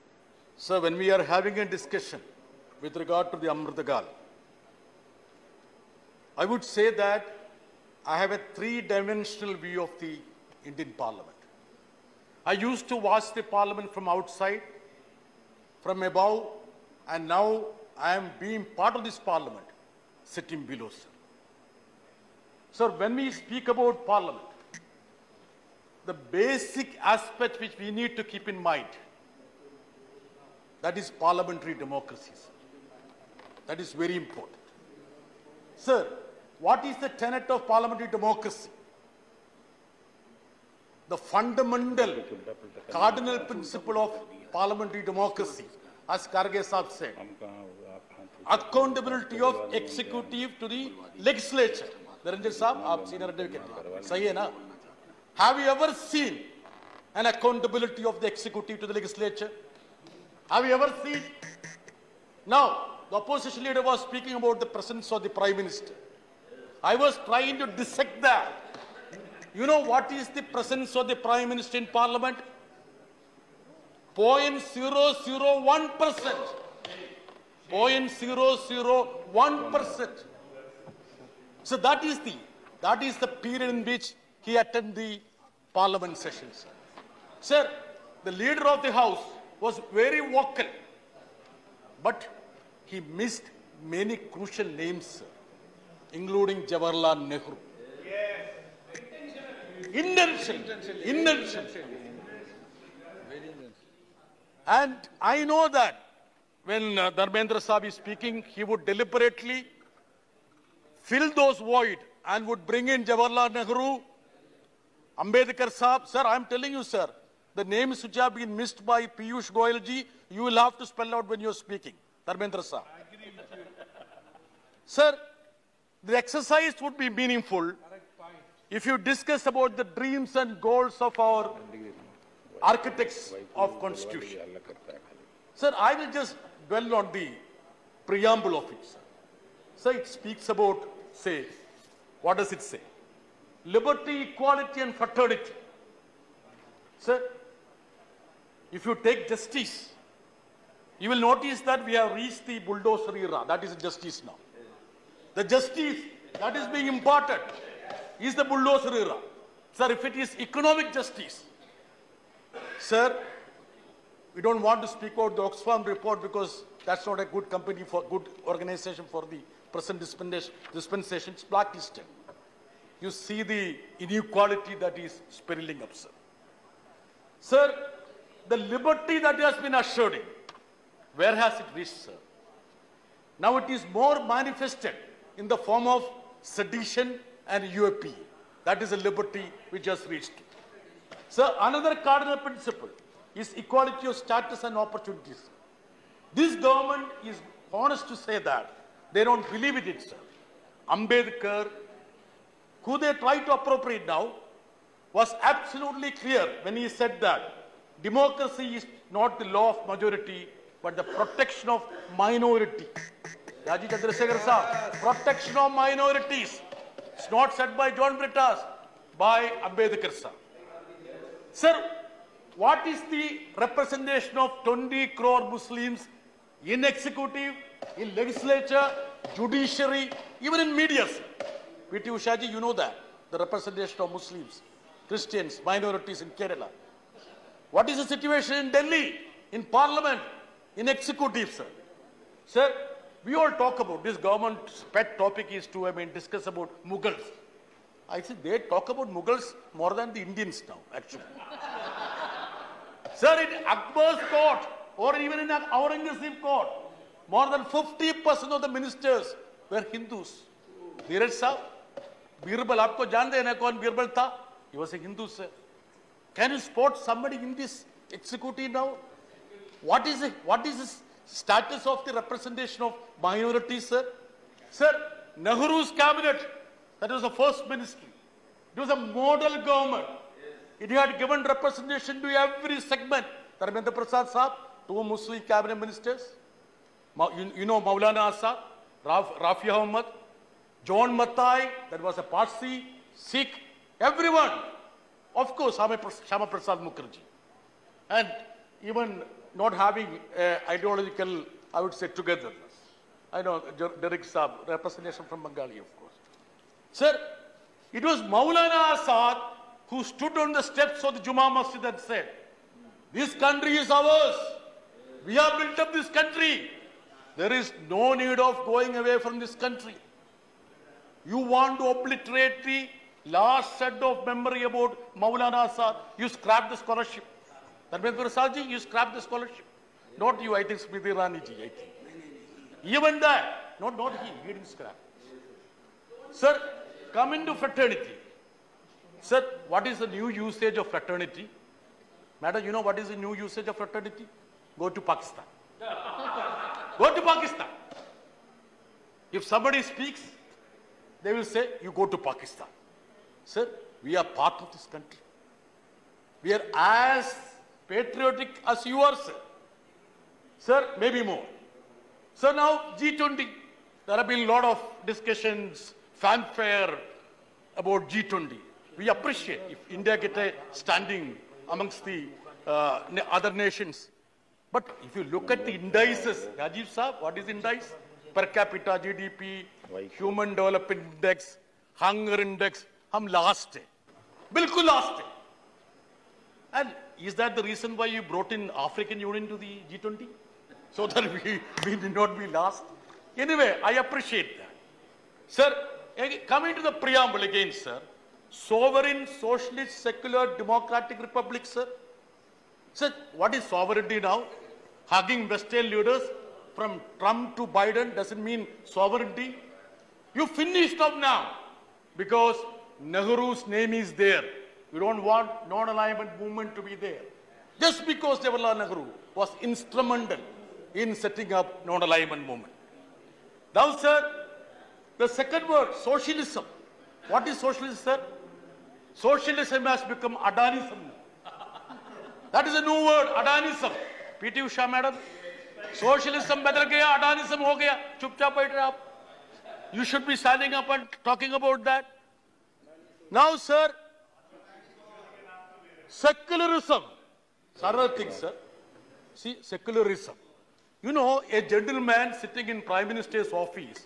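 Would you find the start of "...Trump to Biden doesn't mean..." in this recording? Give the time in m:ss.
6:47.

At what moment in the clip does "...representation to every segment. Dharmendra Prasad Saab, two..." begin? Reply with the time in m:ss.
4:41.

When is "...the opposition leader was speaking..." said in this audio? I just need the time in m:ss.
1:03.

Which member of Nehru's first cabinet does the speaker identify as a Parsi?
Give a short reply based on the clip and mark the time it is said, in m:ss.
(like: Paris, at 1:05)
John Mathai, at 4:50.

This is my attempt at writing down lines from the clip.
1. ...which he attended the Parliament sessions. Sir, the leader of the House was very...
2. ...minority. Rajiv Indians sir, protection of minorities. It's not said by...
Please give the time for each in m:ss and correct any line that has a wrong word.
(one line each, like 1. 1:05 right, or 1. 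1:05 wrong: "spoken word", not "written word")
1. 1:23 right
2. 3:32 wrong: "Chandrasekhar", not "Indians".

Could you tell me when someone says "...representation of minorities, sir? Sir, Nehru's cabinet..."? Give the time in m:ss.
4:32.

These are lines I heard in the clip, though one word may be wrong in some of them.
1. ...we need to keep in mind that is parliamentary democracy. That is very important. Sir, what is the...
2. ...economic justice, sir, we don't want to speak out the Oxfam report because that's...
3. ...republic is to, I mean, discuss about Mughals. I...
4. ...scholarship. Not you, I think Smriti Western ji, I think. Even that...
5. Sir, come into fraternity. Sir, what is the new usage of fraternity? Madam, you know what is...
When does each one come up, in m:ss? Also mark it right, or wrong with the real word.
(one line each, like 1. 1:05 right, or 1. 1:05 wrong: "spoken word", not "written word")
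1. 0:27 right
2. 2:40 right
3. 4:05 wrong: "topic", not "republic"
4. 5:29 wrong: "Irani", not "Western"
5. 5:36 right.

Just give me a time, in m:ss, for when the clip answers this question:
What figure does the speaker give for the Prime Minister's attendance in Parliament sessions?
1:14.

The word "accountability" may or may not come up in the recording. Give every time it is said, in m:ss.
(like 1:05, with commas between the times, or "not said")
0:48, 0:57.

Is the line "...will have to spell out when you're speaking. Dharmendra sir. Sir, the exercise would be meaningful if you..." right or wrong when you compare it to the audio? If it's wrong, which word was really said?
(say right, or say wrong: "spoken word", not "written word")
right.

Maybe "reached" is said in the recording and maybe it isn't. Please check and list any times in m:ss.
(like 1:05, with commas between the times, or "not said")
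2:32, 3:01, 3:10.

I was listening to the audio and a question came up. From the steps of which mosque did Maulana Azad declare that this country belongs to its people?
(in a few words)
Juma Masjid.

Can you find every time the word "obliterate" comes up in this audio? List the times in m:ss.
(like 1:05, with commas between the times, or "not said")
5:21.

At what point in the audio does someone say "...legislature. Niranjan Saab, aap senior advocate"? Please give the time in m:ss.
0:51.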